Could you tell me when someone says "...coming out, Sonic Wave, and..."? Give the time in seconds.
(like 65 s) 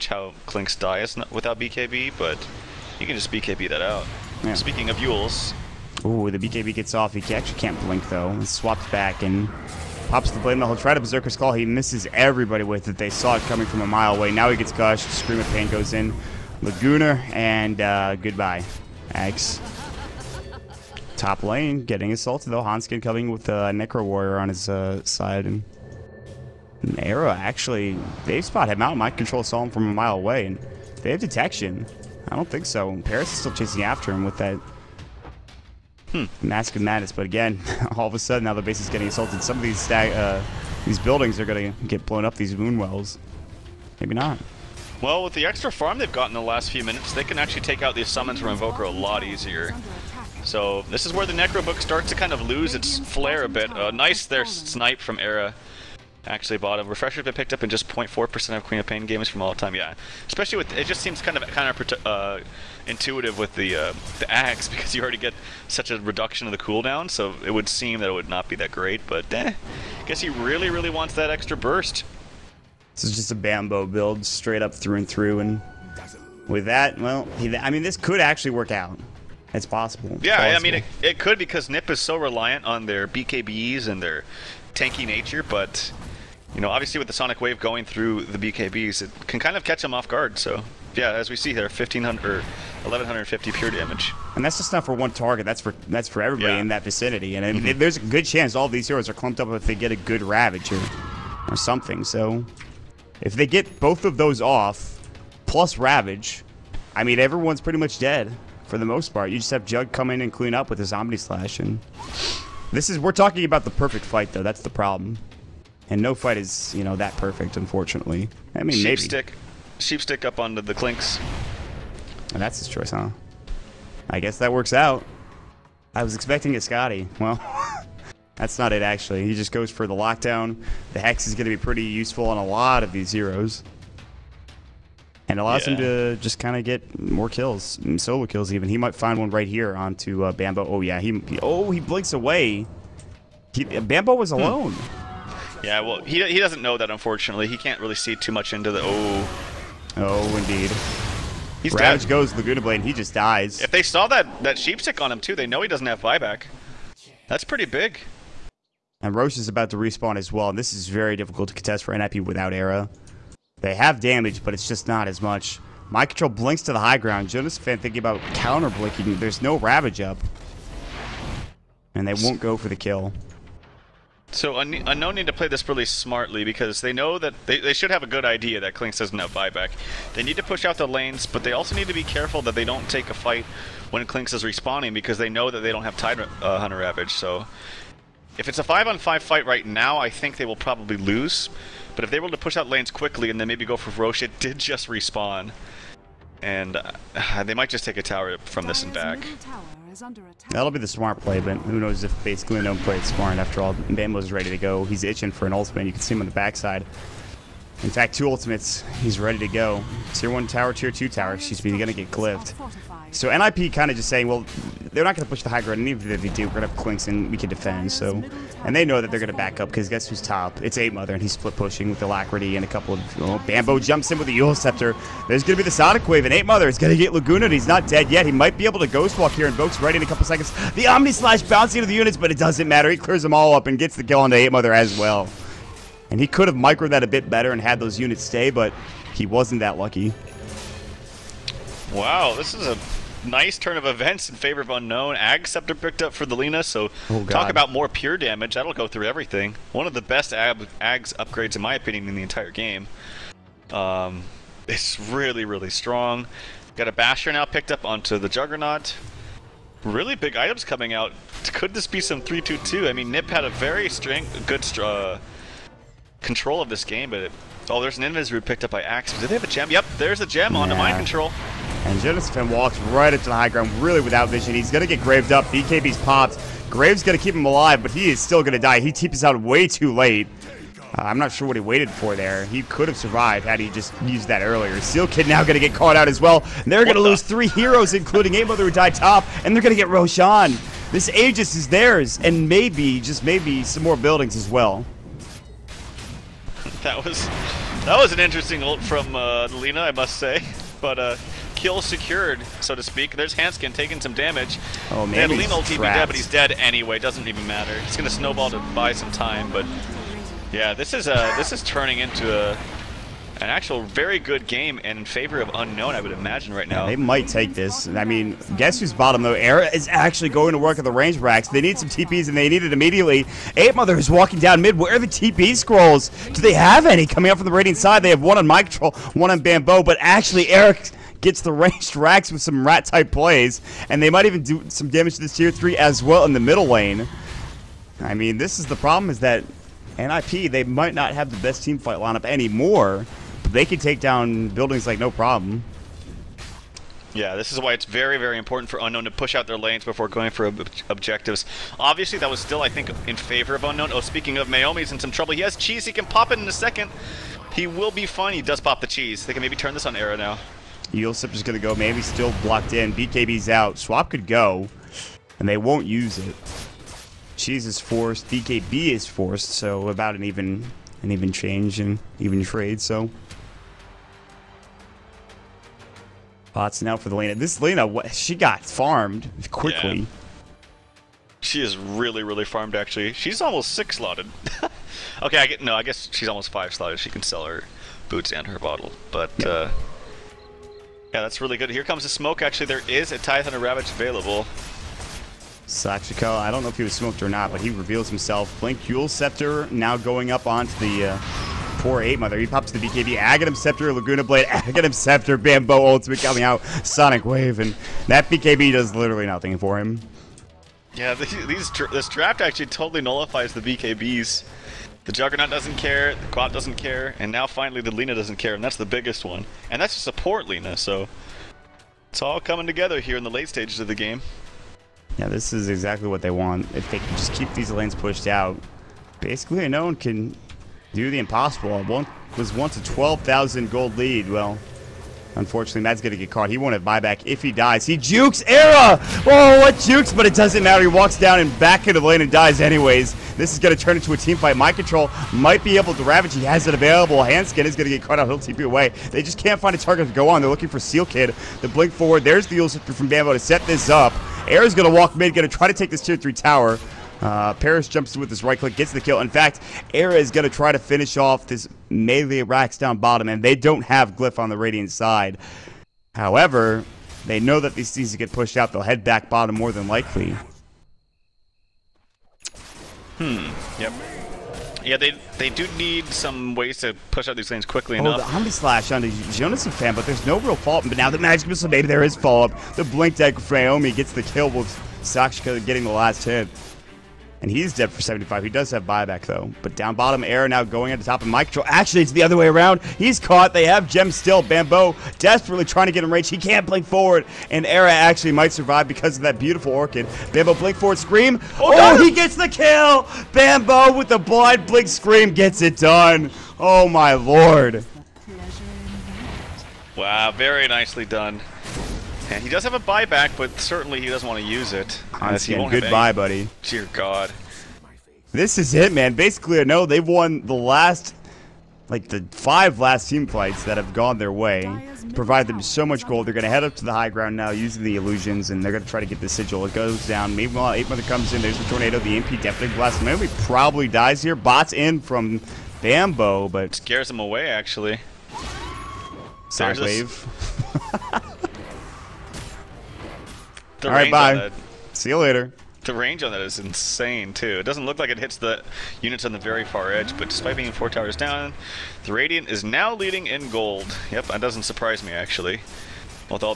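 406 s.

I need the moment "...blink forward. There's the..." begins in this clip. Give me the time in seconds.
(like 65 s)
451 s.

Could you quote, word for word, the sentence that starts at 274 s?
He's going to get graved up.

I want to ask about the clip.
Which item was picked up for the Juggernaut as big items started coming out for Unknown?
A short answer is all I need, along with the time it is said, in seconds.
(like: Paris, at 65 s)
Basher, at 256 s.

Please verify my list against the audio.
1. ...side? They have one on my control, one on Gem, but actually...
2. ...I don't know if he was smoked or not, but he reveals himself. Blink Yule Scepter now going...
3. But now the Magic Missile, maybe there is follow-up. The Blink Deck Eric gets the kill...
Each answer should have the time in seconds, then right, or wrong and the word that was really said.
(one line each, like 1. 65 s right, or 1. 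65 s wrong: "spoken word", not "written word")
1. 327 s wrong: "Bambo", not "Gem"
2. 396 s right
3. 480 s wrong: "Naomi", not "Eric".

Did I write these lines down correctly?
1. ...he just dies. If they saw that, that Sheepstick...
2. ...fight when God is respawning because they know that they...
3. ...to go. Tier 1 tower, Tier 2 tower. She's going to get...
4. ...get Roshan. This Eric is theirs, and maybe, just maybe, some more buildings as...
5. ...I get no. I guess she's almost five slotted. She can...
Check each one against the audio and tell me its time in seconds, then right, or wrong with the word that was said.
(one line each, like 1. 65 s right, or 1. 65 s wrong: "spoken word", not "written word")
1. 152 s right
2. 183 s wrong: "Clinkz", not "God"
3. 209 s right
4. 289 s wrong: "Aegis", not "Eric"
5. 385 s right.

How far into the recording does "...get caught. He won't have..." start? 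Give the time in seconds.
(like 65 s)
436 s.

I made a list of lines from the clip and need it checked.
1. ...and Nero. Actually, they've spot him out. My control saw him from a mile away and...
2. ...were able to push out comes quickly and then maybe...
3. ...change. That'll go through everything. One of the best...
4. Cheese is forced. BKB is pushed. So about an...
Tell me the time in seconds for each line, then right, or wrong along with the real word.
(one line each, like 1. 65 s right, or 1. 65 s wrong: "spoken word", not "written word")
1. 25 s right
2. 192 s wrong: "lanes", not "comes"
3. 248 s wrong: "damage", not "change"
4. 367 s wrong: "forced", not "pushed".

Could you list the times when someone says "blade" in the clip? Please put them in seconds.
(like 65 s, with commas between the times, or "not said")
10 s, 152 s, 404 s.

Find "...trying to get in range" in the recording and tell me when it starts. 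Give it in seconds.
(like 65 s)
495 s.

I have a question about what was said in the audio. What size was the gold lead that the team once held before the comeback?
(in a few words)
12,000 gold.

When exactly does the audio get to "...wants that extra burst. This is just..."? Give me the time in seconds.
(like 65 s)
70 s.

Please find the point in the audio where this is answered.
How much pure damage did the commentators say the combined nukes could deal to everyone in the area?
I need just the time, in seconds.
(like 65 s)
92 s.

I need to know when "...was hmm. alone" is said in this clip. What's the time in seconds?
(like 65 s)
144 s.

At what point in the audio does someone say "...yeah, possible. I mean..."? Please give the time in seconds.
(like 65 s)
80 s.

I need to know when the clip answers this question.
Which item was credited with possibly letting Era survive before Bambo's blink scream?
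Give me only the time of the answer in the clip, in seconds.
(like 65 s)
499 s.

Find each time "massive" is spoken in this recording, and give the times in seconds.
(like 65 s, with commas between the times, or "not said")
not said.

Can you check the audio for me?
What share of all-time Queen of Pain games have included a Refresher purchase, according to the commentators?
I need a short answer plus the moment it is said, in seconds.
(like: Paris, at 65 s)
0.4%, at 57 s.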